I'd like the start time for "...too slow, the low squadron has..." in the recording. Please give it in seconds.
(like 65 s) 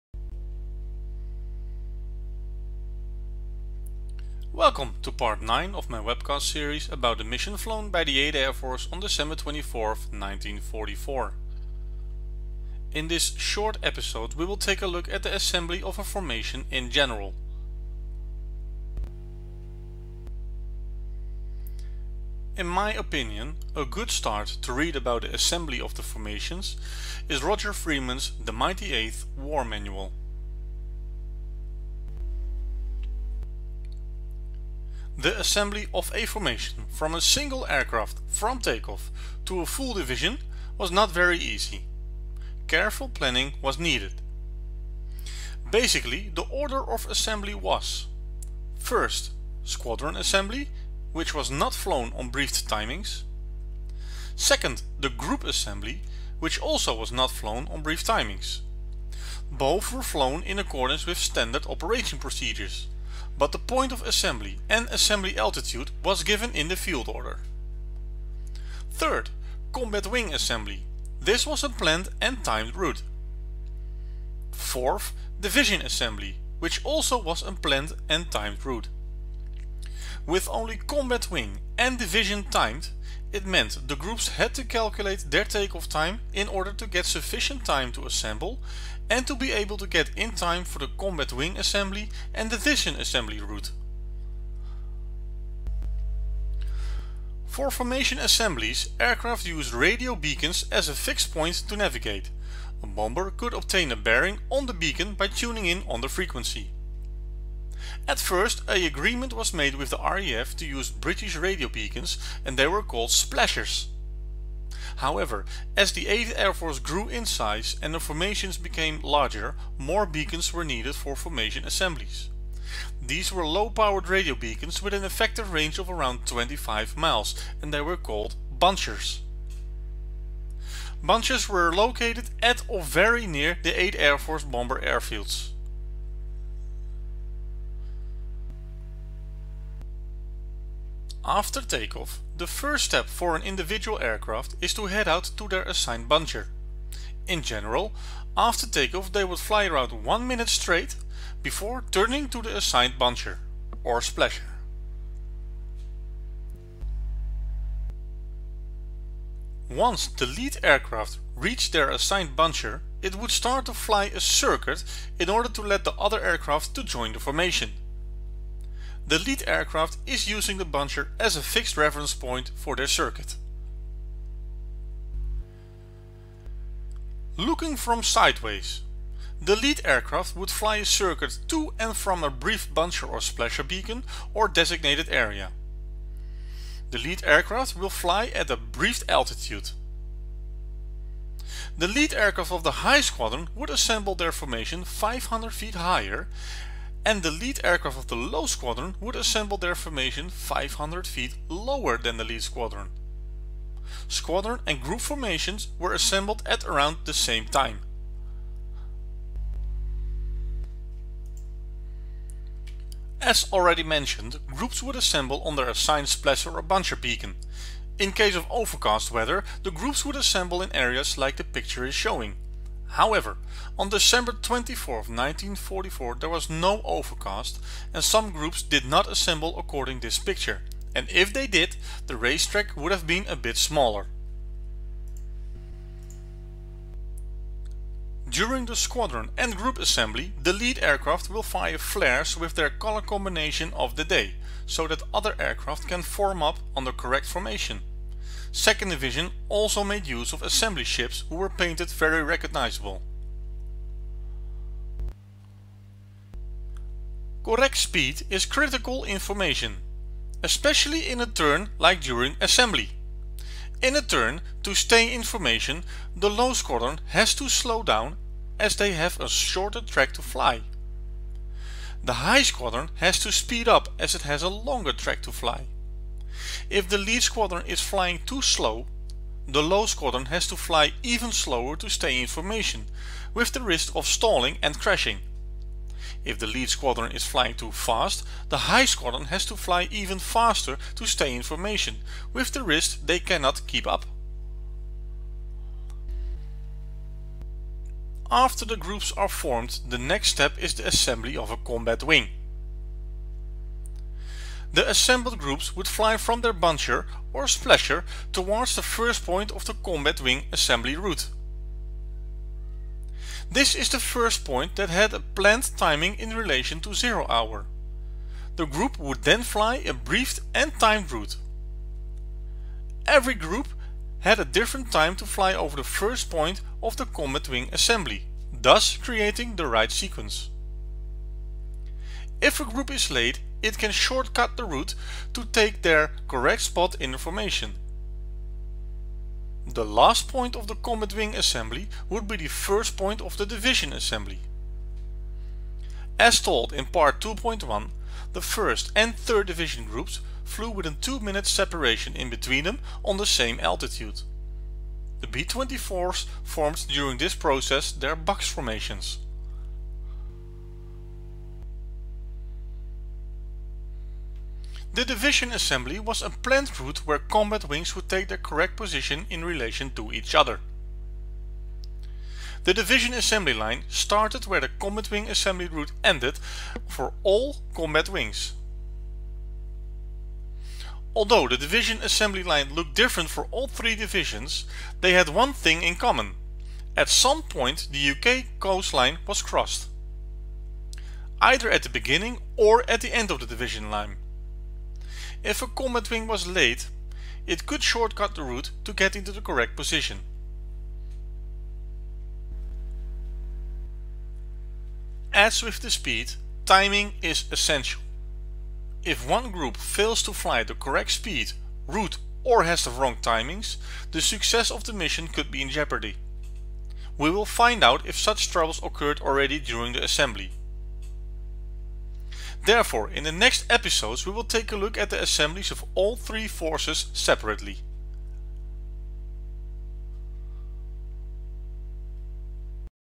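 278 s.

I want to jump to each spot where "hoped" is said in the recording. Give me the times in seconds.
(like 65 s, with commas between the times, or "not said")
not said.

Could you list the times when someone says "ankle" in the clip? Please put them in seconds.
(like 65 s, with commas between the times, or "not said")
not said.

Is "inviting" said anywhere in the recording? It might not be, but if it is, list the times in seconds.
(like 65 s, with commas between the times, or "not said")
not said.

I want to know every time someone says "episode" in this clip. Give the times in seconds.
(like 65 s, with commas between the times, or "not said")
13 s, 423 s.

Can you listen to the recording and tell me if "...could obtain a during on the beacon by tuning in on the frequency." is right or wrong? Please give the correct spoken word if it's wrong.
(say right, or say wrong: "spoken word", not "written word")
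wrong: "bearing", not "during".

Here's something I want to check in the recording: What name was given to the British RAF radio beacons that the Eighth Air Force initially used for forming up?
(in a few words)
splashers.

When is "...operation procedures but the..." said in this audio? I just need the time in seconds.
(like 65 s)
61 s.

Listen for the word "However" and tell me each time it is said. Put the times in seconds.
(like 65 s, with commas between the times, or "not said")
114 s, 222 s.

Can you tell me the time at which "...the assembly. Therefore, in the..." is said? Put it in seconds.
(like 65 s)
419 s.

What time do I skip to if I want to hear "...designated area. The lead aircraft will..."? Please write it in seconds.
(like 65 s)
184 s.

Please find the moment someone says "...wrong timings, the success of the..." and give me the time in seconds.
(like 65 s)
412 s.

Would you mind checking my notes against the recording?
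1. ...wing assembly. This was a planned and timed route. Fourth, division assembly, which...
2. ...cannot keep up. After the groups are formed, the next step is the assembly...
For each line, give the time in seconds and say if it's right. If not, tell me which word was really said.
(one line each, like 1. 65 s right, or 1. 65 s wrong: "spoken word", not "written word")
1. 70 s right
2. 293 s right.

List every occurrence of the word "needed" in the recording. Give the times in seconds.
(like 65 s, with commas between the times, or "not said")
43 s, 120 s.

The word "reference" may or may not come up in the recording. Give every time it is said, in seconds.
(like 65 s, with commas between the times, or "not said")
171 s.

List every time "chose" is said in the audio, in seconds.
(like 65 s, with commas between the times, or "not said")
not said.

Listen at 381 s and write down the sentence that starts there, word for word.
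Although the division assembly line looked different for all three divisions, they had one thing in common.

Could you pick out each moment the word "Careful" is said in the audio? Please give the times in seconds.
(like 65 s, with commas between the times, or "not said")
42 s.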